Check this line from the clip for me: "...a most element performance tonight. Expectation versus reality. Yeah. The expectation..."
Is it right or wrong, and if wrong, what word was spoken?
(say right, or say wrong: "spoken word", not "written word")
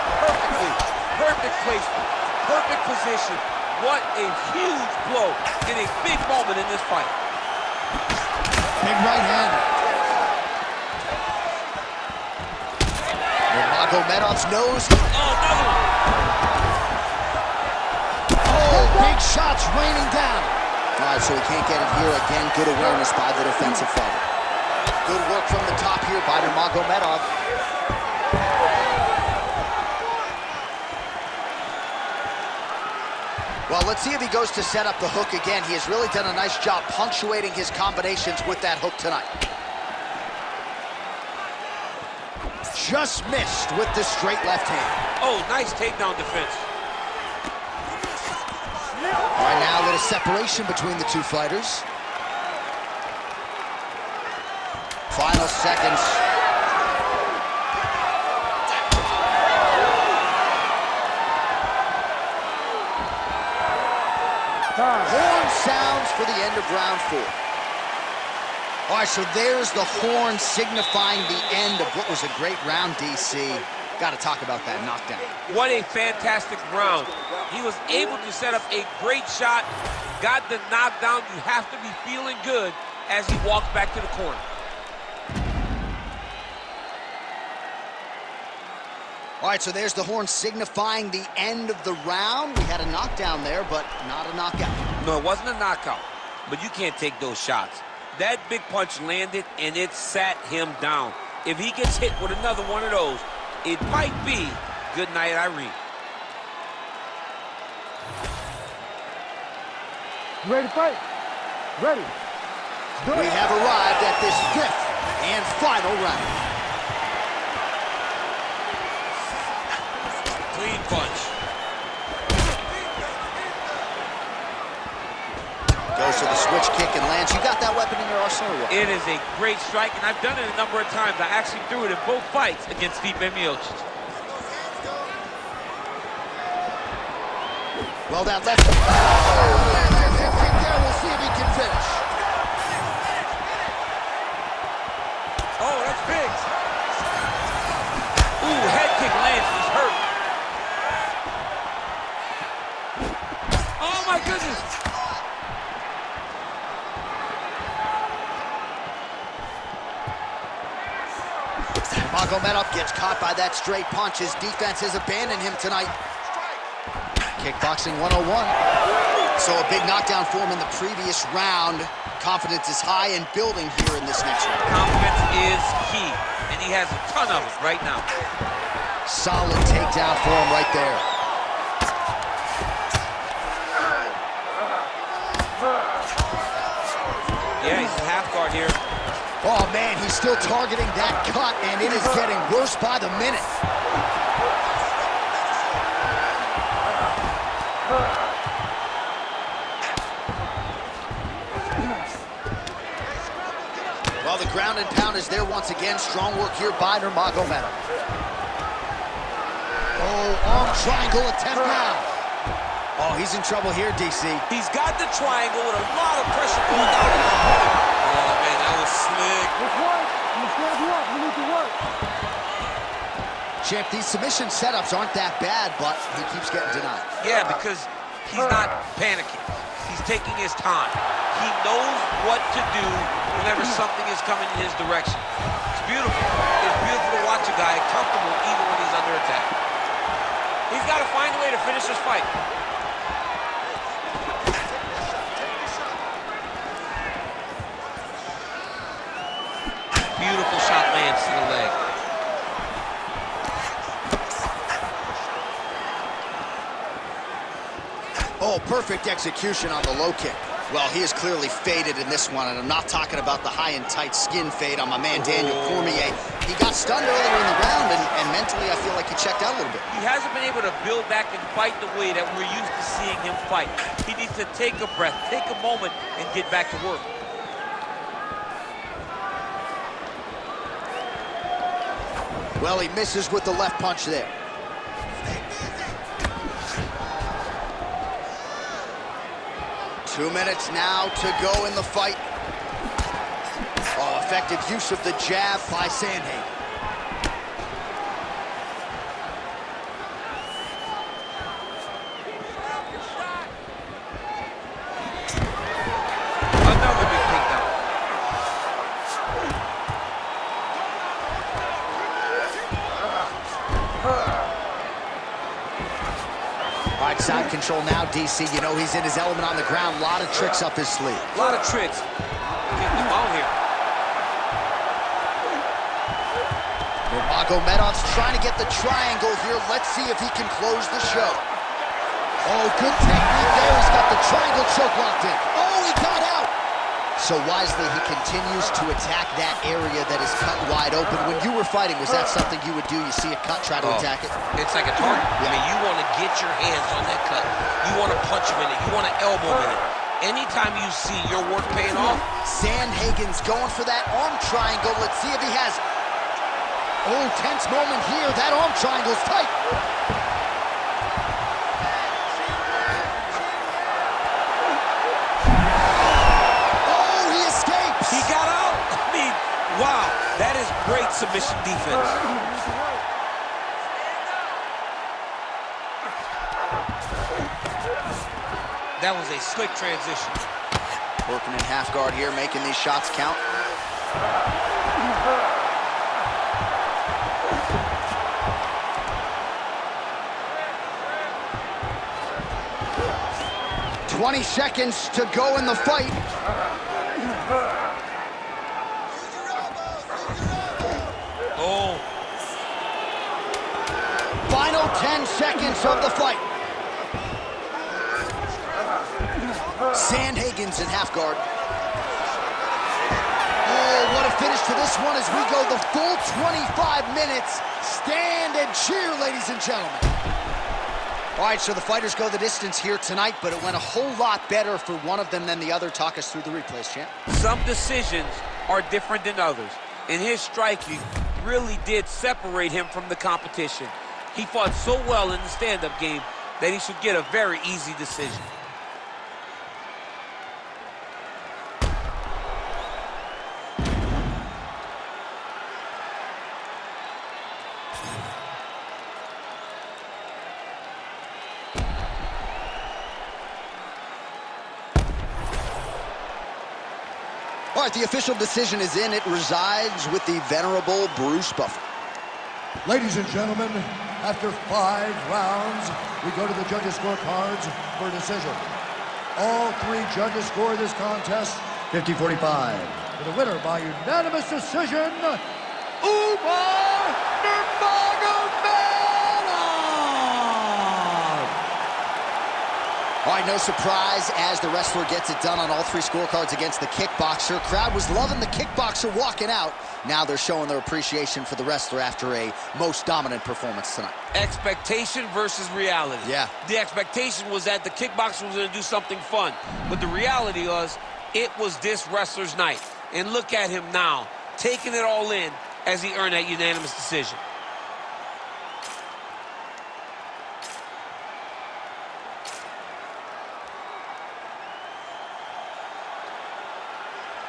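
wrong: "dominant", not "element".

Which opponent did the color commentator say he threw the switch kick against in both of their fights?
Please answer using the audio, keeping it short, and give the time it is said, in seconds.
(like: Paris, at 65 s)
Stipe Miocic, at 133 s.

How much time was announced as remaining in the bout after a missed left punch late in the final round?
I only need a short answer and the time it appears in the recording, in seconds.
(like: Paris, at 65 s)
2 minutes, at 290 s.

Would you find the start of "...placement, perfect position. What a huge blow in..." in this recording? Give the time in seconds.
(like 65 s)
1 s.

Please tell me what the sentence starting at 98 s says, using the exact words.
That big punch landed, and it sat him down.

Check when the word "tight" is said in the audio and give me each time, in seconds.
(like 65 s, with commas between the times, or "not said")
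263 s, 359 s.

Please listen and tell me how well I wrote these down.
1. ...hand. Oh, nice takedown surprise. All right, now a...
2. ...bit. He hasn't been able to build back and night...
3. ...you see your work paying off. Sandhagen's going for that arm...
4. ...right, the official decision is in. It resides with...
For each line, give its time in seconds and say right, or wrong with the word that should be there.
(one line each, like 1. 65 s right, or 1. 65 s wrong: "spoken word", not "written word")
1. 44 s wrong: "defense", not "surprise"
2. 269 s wrong: "fight", not "night"
3. 350 s right
4. 457 s right.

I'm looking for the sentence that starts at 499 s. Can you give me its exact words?
But the reality was it was this wrestler's night.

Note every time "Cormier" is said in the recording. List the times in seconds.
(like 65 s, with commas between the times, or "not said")
265 s.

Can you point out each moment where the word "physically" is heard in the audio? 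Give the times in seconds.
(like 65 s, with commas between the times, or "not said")
not said.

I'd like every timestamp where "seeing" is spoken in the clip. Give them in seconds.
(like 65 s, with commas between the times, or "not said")
272 s.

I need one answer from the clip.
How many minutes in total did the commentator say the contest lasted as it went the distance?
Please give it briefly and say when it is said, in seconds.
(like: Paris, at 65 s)
25, at 416 s.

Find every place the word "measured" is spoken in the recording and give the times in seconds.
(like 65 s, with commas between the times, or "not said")
not said.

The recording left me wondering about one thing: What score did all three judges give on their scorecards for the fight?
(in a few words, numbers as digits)
50-45.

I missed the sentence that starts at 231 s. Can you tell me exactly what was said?
He knows what to do whenever something is coming in his direction.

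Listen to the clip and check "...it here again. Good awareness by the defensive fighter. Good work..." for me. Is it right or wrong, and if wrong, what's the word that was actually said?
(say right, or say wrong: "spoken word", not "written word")
right.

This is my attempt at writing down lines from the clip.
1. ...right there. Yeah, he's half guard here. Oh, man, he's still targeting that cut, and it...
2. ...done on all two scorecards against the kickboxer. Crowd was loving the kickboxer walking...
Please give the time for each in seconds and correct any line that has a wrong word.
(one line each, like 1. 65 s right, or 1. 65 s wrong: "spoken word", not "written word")
1. 180 s right
2. 485 s wrong: "three", not "two".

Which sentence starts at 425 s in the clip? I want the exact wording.
Talk us through the replays, champ.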